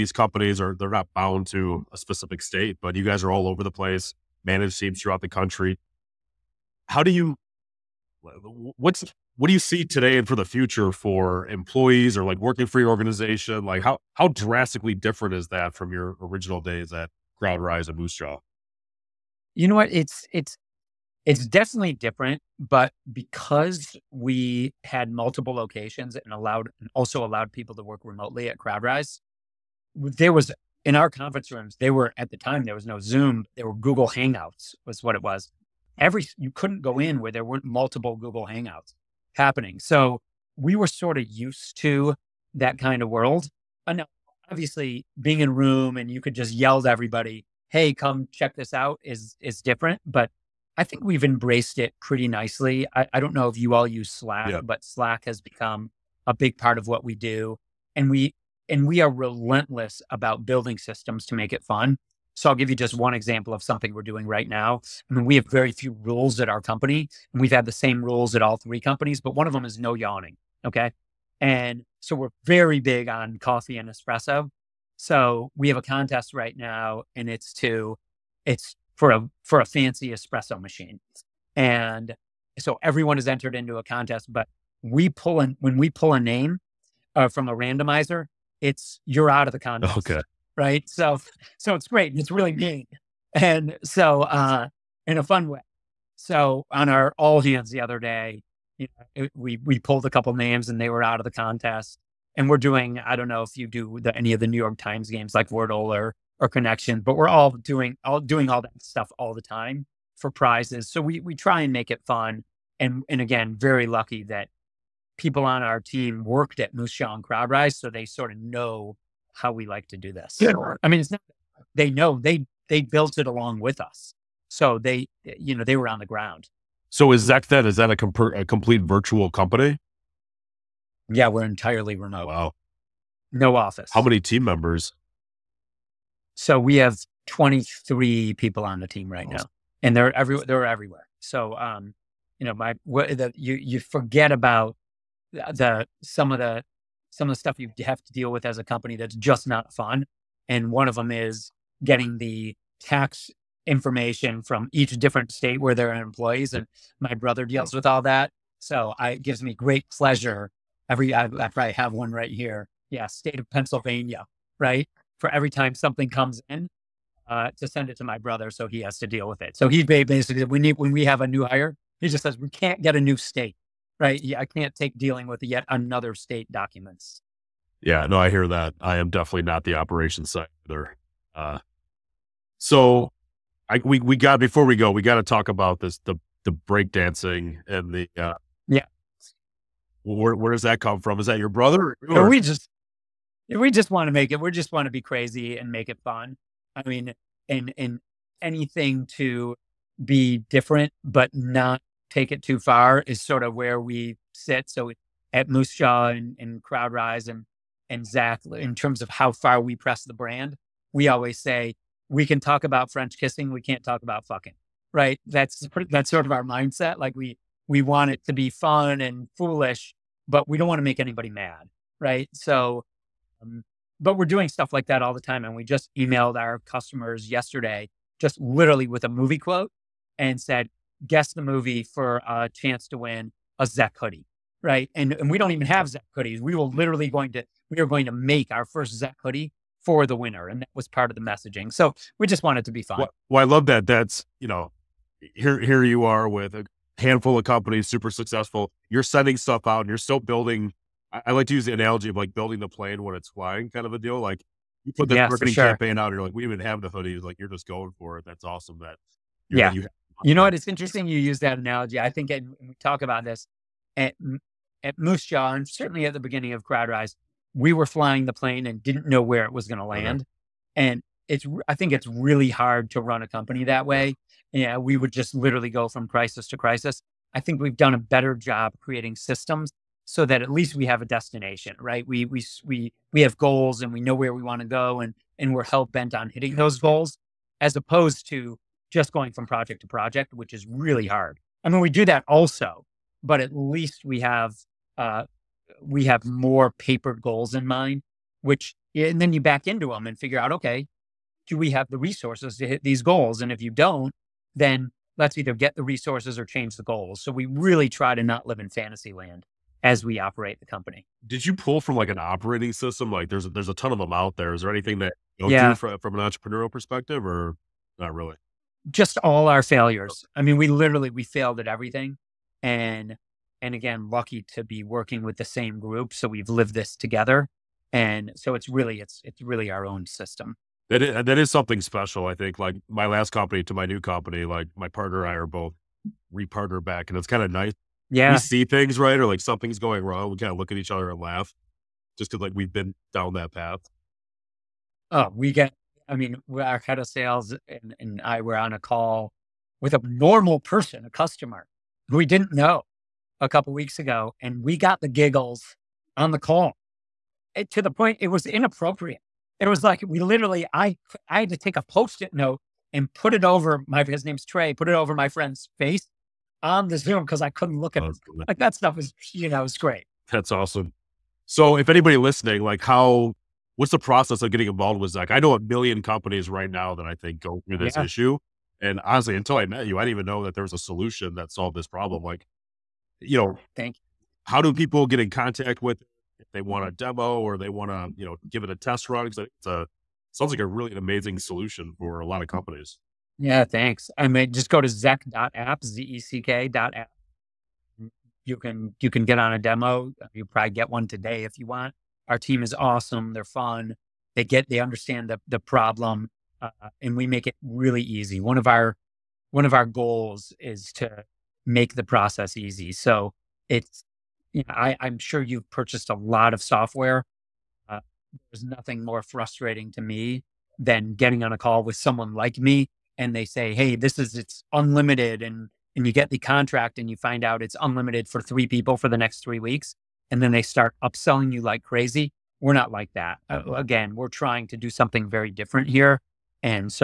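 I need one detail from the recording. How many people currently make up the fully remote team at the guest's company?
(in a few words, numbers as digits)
23.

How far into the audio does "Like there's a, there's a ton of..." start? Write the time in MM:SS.
05:13.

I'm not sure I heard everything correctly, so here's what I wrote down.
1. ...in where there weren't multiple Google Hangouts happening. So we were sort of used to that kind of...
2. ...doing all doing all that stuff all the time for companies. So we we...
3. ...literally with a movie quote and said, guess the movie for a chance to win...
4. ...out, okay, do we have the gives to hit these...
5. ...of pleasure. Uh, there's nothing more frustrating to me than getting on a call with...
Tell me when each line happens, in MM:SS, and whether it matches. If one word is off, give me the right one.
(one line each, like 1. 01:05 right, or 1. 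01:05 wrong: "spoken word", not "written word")
1. 00:36 right
2. 01:47 wrong: "prizes", not "companies"
3. 03:48 right
4. 05:00 wrong: "resources", not "gives"
5. 06:56 wrong: "software", not "pleasure".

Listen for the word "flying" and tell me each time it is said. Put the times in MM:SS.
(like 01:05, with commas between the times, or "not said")
04:13, 04:27.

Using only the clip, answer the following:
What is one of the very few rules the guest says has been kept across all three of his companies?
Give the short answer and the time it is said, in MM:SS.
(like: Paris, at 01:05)
No yawning, at 01:09.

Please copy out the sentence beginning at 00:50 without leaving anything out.
But I think we've embraced it pretty nicely.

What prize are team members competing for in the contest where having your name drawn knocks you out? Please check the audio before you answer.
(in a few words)
Espresso machine.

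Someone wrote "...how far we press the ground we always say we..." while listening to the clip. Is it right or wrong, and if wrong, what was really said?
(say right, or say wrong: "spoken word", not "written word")
wrong: "brand", not "ground".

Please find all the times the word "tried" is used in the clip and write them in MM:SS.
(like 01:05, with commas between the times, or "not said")
not said.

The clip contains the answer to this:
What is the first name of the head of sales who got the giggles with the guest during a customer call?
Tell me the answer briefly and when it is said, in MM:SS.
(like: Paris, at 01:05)
Trey, at 06:04.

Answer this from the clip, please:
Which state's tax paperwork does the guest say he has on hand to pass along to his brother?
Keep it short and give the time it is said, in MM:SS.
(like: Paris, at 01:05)
Pennsylvania, at 02:43.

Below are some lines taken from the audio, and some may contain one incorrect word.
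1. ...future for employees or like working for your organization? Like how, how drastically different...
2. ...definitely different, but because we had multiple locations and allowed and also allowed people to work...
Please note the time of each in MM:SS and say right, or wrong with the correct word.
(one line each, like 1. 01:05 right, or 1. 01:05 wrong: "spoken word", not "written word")
1. 00:10 right
2. 00:21 right.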